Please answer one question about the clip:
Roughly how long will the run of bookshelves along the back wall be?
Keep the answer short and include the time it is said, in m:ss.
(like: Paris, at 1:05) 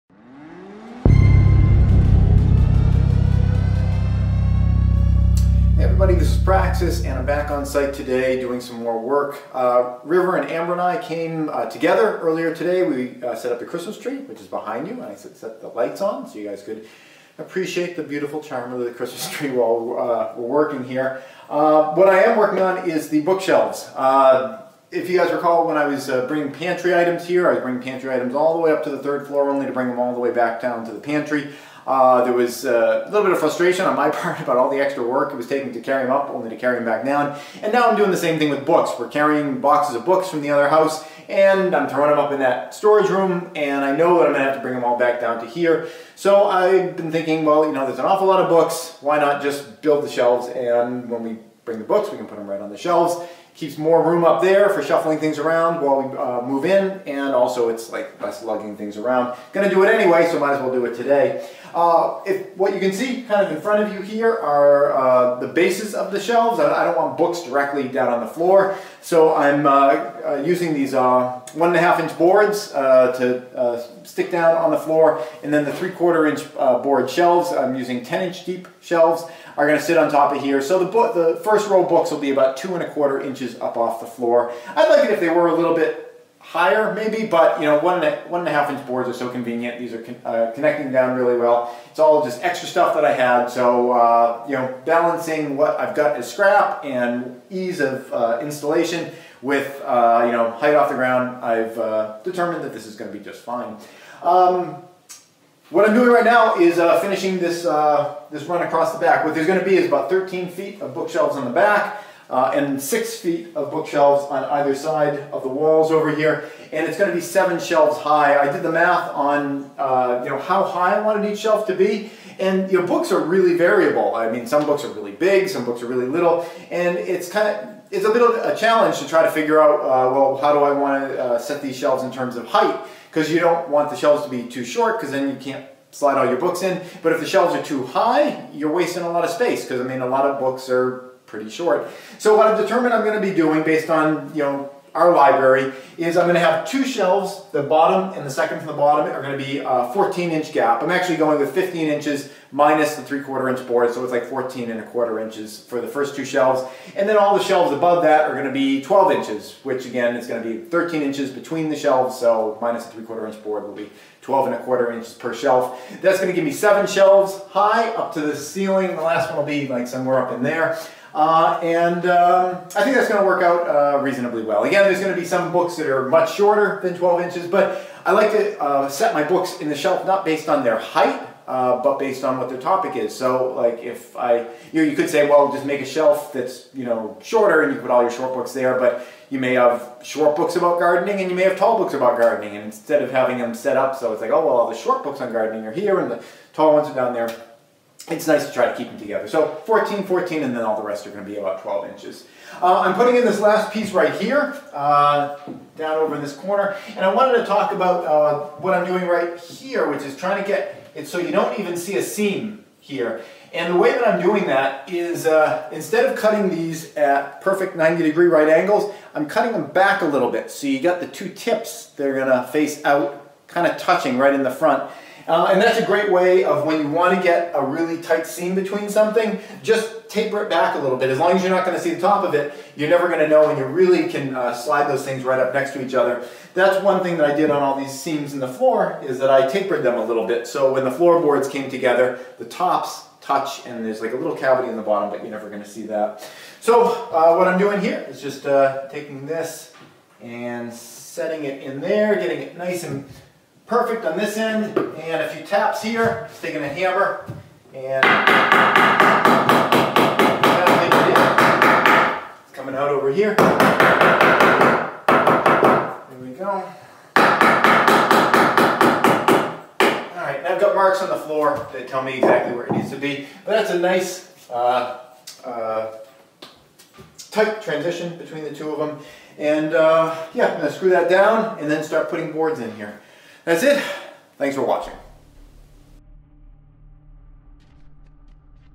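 13 feet, at 1:50.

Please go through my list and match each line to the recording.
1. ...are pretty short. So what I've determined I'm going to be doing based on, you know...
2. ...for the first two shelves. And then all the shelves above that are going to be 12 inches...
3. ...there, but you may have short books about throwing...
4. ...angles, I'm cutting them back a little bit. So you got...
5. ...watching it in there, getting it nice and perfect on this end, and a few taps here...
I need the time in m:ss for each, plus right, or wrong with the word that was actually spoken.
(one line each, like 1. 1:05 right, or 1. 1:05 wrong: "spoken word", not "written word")
1. 2:20 right
2. 2:35 right
3. 3:08 wrong: "gardening", not "throwing"
4. 3:38 right
5. 4:10 wrong: "setting", not "watching".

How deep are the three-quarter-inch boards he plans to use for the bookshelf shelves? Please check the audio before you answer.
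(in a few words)
10 inches.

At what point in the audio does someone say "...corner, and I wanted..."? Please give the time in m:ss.
3:26.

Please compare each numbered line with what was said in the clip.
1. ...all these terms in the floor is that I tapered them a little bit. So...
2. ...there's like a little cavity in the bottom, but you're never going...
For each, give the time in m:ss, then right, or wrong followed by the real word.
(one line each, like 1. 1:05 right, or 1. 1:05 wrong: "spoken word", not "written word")
1. 3:57 wrong: "seams", not "terms"
2. 4:03 right.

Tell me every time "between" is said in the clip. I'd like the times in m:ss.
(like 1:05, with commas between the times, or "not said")
2:41, 3:48, 4:38.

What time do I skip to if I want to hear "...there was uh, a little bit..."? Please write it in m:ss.
0:32.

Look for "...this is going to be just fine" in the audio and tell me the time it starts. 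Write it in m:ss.
1:42.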